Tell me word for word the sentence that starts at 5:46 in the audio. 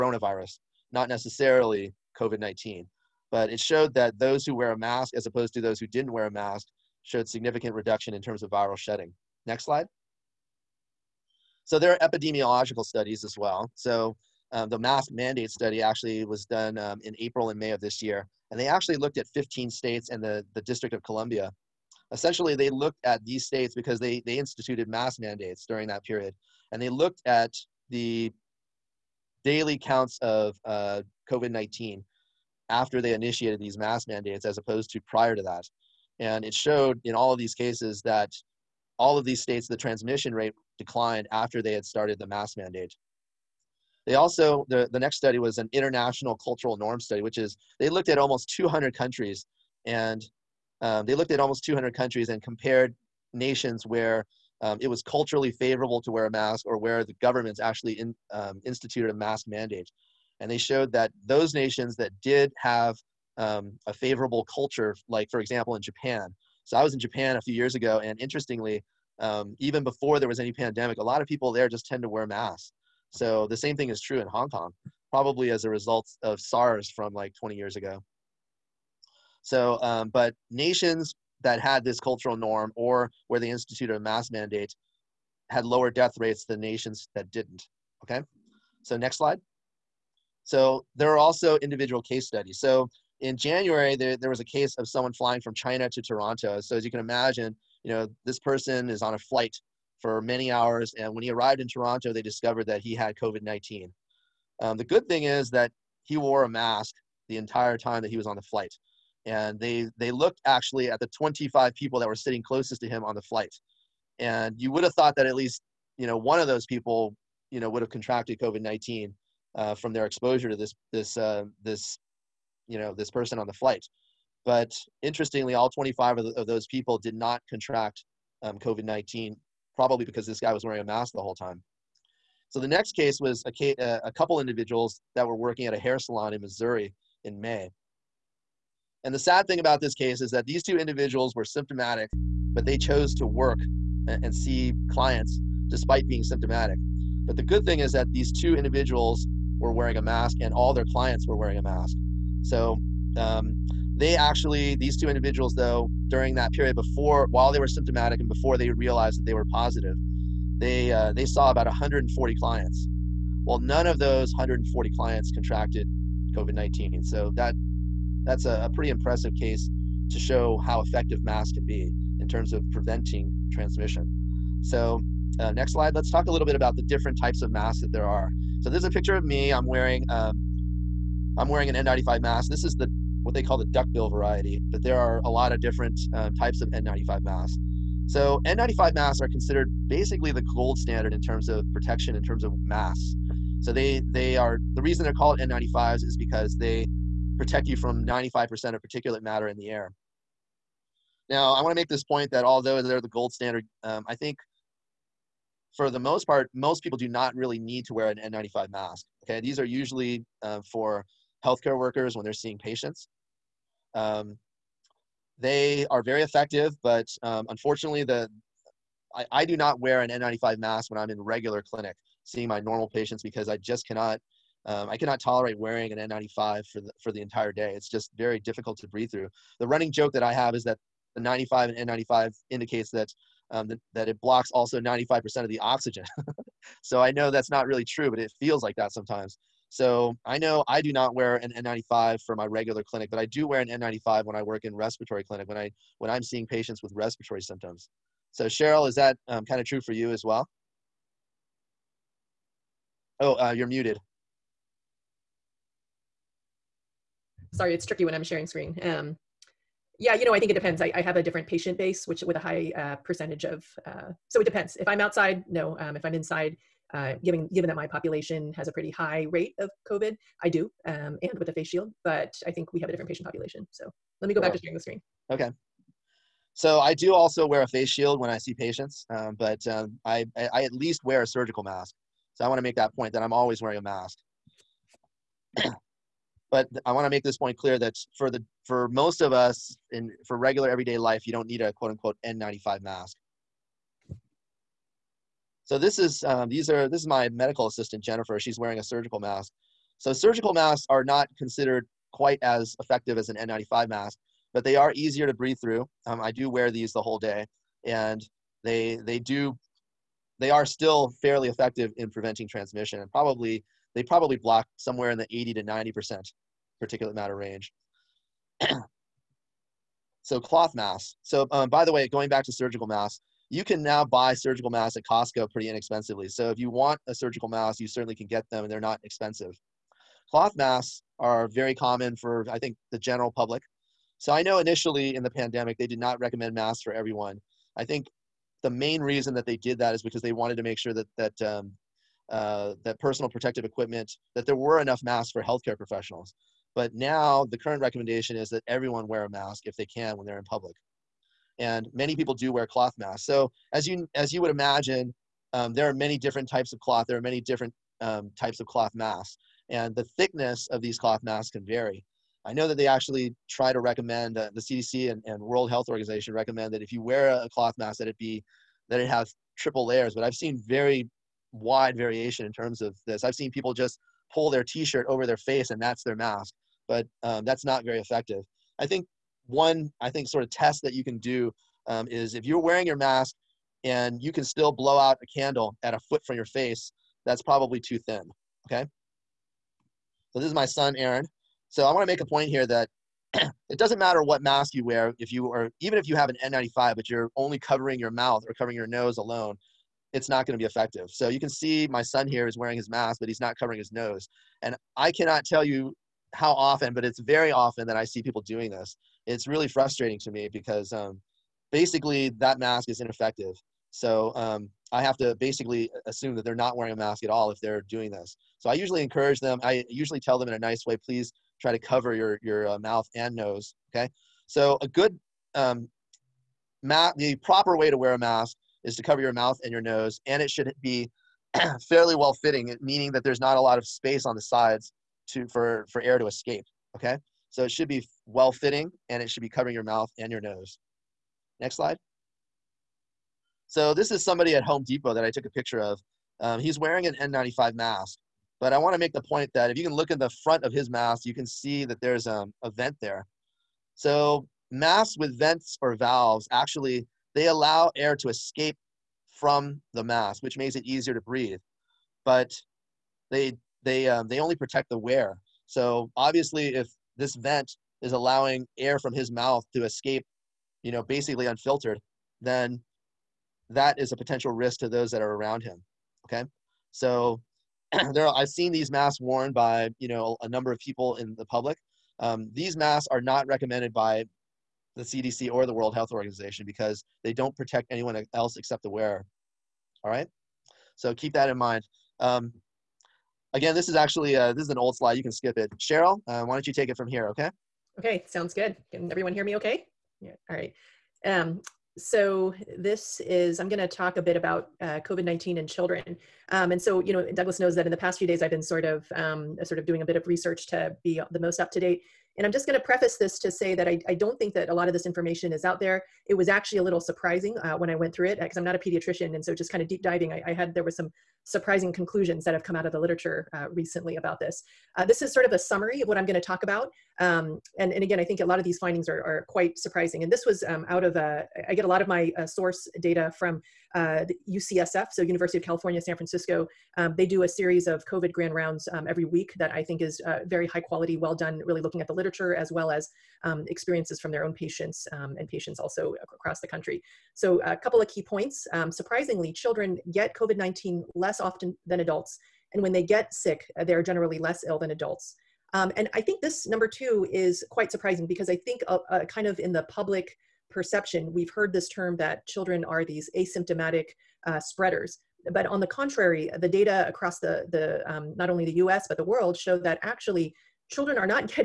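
But now the current recommendation is that everyone wear a mask if they can when they're in public.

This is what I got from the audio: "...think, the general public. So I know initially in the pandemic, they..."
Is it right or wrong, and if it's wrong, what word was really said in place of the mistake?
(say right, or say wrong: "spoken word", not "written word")
right.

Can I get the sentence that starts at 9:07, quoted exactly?
So a couple of key points.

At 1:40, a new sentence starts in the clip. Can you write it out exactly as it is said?
And when he arrived in Toronto, they discovered that he had COVID 19.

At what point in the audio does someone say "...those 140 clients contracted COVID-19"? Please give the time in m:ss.
2:43.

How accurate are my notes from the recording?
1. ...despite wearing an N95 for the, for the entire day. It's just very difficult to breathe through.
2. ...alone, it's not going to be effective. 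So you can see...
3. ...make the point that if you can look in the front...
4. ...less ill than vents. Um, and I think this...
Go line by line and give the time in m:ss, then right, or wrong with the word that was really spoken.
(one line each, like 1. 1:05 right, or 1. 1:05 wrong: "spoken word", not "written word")
1. 3:45 wrong: "tolerate", not "despite"
2. 6:39 right
3. 7:28 right
4. 9:14 wrong: "adults", not "vents".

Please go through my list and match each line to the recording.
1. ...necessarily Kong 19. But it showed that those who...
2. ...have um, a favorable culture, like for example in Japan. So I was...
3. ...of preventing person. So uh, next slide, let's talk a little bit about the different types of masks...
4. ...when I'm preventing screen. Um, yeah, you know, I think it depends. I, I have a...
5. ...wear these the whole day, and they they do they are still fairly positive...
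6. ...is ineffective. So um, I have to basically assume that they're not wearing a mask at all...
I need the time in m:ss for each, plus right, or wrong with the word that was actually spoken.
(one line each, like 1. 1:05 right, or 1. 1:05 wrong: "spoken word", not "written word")
1. 0:01 wrong: "COVID", not "Kong"
2. 1:02 right
3. 2:52 wrong: "transmission", not "person"
4. 4:18 wrong: "sharing", not "preventing"
5. 5:06 wrong: "effective", not "positive"
6. 6:52 right.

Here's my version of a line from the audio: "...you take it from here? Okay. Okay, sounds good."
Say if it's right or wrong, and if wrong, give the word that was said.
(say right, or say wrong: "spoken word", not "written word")
right.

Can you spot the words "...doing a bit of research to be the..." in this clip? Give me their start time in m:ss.
8:29.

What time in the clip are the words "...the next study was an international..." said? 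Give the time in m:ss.
0:44.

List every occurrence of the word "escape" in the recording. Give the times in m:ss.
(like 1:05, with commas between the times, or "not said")
7:16, 7:38, 7:49.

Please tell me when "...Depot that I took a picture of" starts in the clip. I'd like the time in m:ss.
7:24.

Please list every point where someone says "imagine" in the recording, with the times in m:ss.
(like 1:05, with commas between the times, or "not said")
1:37, 5:54.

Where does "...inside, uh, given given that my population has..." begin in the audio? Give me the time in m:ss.
4:26.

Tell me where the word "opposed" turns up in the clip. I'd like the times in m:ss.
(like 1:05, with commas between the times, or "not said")
0:05, 0:34.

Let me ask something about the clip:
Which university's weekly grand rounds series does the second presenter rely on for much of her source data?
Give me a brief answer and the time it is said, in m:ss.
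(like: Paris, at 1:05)
UCSF, at 8:54.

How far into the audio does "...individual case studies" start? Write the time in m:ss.
1:31.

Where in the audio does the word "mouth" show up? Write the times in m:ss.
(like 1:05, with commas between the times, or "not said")
6:38, 7:02, 7:09, 7:19, 7:30, 7:49.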